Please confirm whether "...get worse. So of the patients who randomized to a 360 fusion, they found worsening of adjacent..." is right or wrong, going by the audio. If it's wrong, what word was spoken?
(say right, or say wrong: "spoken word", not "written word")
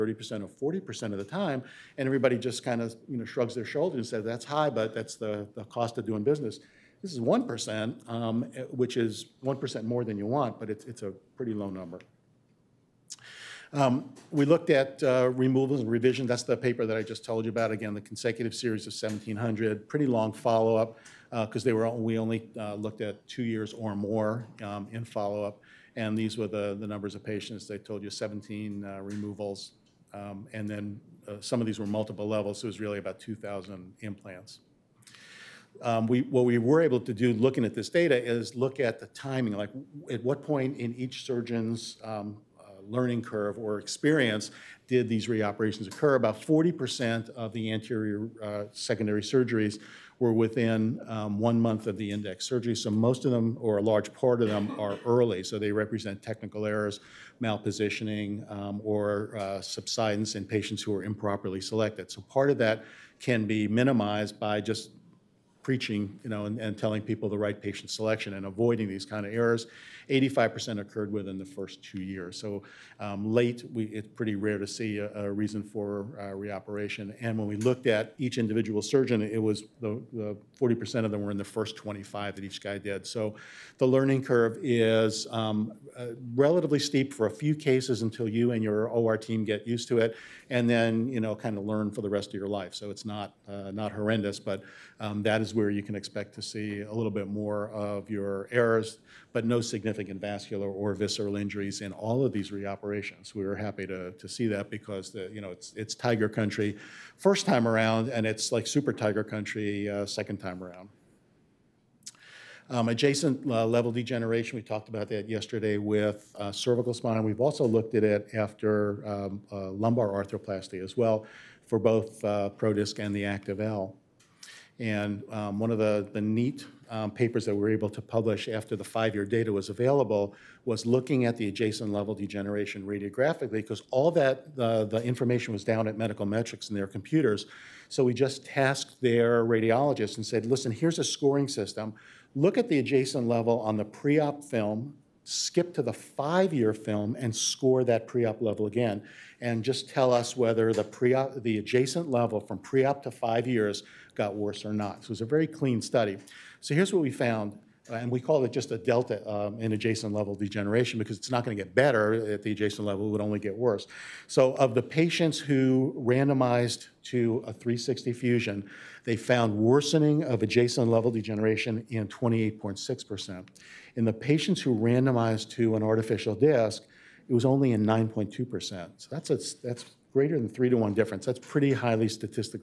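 right.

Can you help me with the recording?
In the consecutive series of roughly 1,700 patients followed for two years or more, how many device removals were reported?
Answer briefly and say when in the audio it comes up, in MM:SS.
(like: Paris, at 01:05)
17, at 00:28.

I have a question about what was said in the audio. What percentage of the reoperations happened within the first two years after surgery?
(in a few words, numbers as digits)
85%.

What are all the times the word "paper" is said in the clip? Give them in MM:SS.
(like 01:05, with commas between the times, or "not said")
00:16, 02:07.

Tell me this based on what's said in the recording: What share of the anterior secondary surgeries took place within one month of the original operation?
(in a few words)
40%.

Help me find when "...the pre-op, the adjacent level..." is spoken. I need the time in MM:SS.
02:30.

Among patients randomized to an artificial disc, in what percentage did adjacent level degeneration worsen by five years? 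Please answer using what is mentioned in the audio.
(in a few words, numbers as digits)
9.2%.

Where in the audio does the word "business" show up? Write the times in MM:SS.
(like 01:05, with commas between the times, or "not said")
00:06.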